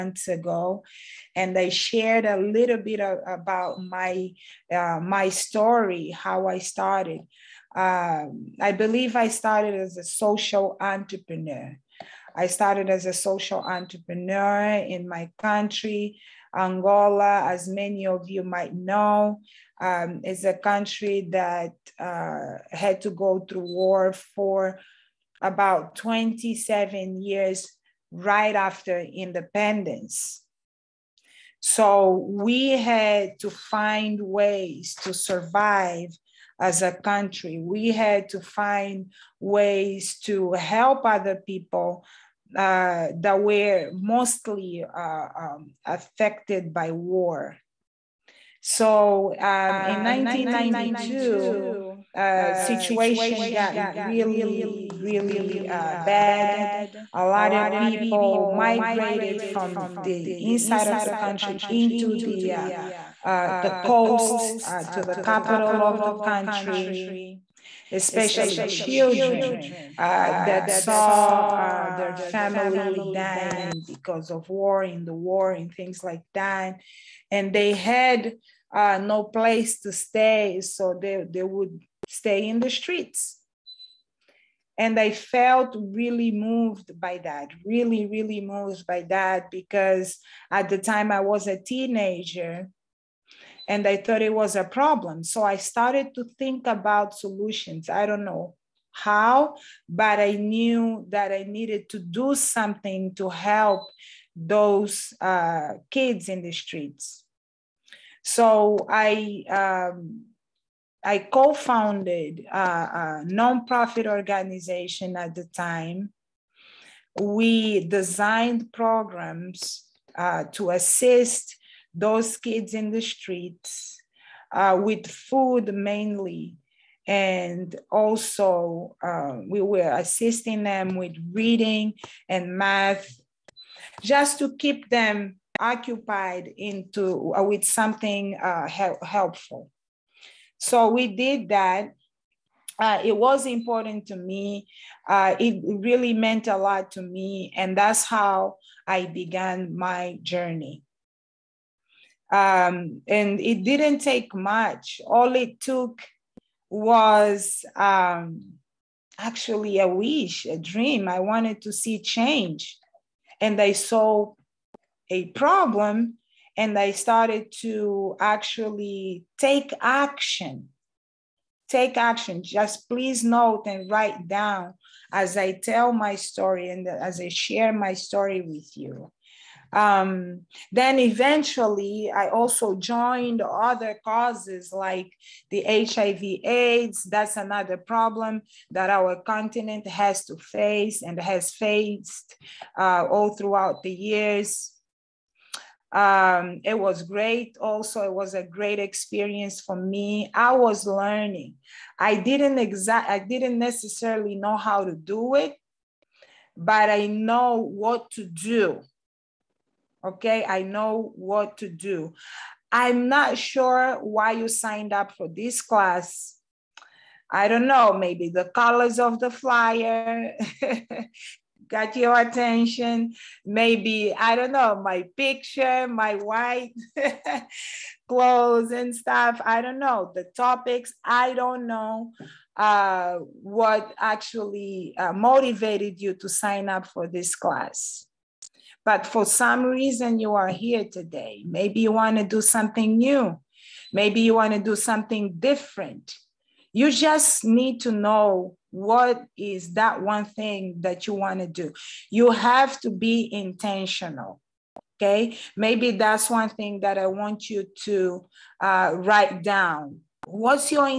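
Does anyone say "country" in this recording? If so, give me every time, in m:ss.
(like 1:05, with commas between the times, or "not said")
0:15, 0:20, 0:36, 1:01, 1:06.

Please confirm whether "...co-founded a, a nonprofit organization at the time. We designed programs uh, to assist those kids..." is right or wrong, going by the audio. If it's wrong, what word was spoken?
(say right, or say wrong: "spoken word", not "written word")
right.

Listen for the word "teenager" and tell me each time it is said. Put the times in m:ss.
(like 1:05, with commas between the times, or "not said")
1:31.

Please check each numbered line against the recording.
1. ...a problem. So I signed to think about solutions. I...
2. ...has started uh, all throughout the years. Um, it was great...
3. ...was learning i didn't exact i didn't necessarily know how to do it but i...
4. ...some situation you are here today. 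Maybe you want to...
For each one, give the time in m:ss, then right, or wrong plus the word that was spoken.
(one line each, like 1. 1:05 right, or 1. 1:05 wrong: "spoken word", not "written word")
1. 1:34 wrong: "started", not "signed"
2. 3:11 wrong: "faced", not "started"
3. 3:20 right
4. 3:59 wrong: "reason", not "situation".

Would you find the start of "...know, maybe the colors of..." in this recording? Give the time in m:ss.
3:37.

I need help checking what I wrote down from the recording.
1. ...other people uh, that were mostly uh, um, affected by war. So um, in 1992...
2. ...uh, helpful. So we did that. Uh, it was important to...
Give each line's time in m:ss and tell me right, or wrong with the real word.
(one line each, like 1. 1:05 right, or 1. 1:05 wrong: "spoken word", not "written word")
1. 0:41 right
2. 2:18 right.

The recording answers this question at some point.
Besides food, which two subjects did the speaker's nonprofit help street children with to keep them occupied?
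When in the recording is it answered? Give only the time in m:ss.
2:11.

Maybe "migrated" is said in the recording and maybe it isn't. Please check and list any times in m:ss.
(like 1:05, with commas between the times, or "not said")
0:58.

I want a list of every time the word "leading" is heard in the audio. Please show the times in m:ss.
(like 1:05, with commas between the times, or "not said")
not said.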